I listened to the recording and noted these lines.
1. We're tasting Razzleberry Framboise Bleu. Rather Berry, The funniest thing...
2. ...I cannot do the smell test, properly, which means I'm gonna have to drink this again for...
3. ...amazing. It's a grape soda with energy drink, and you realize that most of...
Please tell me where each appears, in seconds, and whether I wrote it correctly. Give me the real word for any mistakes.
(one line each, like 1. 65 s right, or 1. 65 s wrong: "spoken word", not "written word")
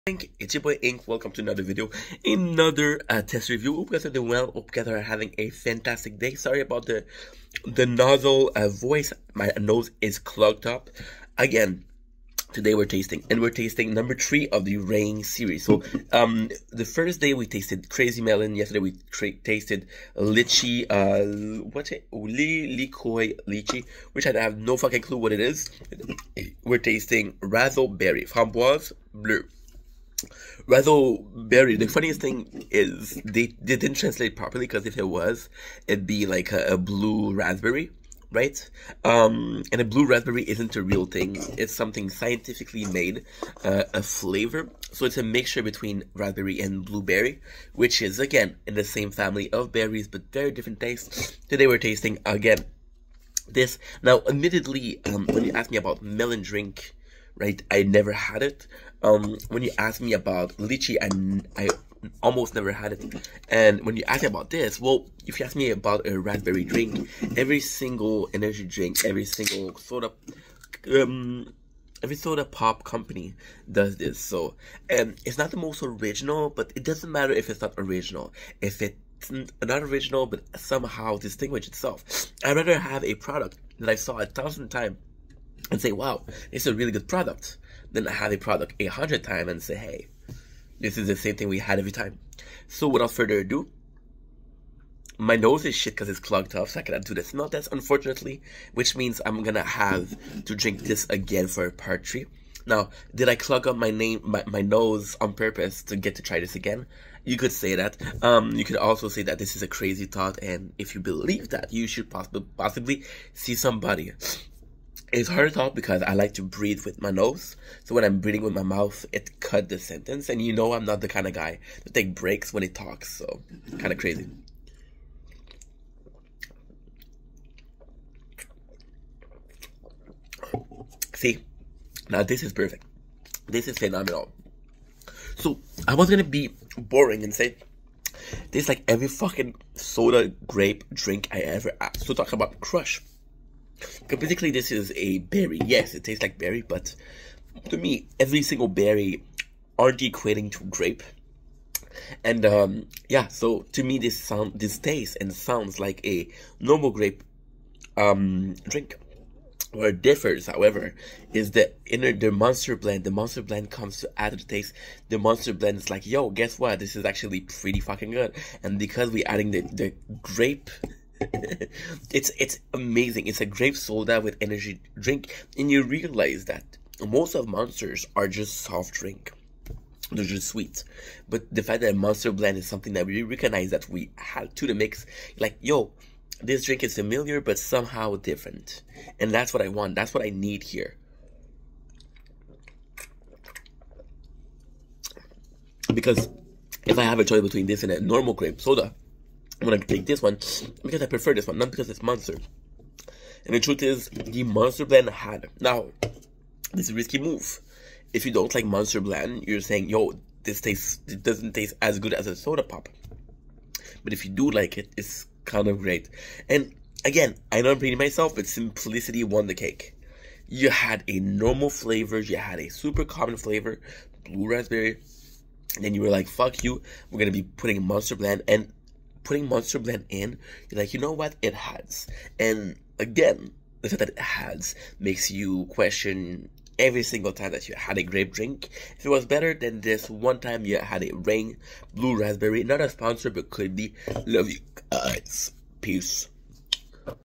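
1. 26 s right
2. 96 s wrong: "unfortunately", not "properly"
3. 172 s right.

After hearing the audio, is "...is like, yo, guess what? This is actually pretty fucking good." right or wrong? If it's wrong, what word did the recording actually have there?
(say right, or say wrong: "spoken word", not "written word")
right.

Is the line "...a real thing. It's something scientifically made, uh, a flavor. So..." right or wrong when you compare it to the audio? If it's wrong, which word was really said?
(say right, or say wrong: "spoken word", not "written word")
right.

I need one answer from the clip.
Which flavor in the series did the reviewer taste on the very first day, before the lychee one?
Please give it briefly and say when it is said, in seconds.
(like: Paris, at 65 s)
Crazy Melon, at 17 s.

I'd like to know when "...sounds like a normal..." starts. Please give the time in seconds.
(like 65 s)
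155 s.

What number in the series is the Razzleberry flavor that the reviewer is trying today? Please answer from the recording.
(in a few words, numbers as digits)
3.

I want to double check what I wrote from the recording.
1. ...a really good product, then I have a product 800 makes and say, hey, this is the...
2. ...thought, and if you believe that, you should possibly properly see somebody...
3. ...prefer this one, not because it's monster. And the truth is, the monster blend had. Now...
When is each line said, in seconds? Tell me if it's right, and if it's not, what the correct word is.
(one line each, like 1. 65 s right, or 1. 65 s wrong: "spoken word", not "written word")
1. 86 s wrong: "times", not "makes"
2. 110 s wrong: "possibly", not "properly"
3. 201 s right.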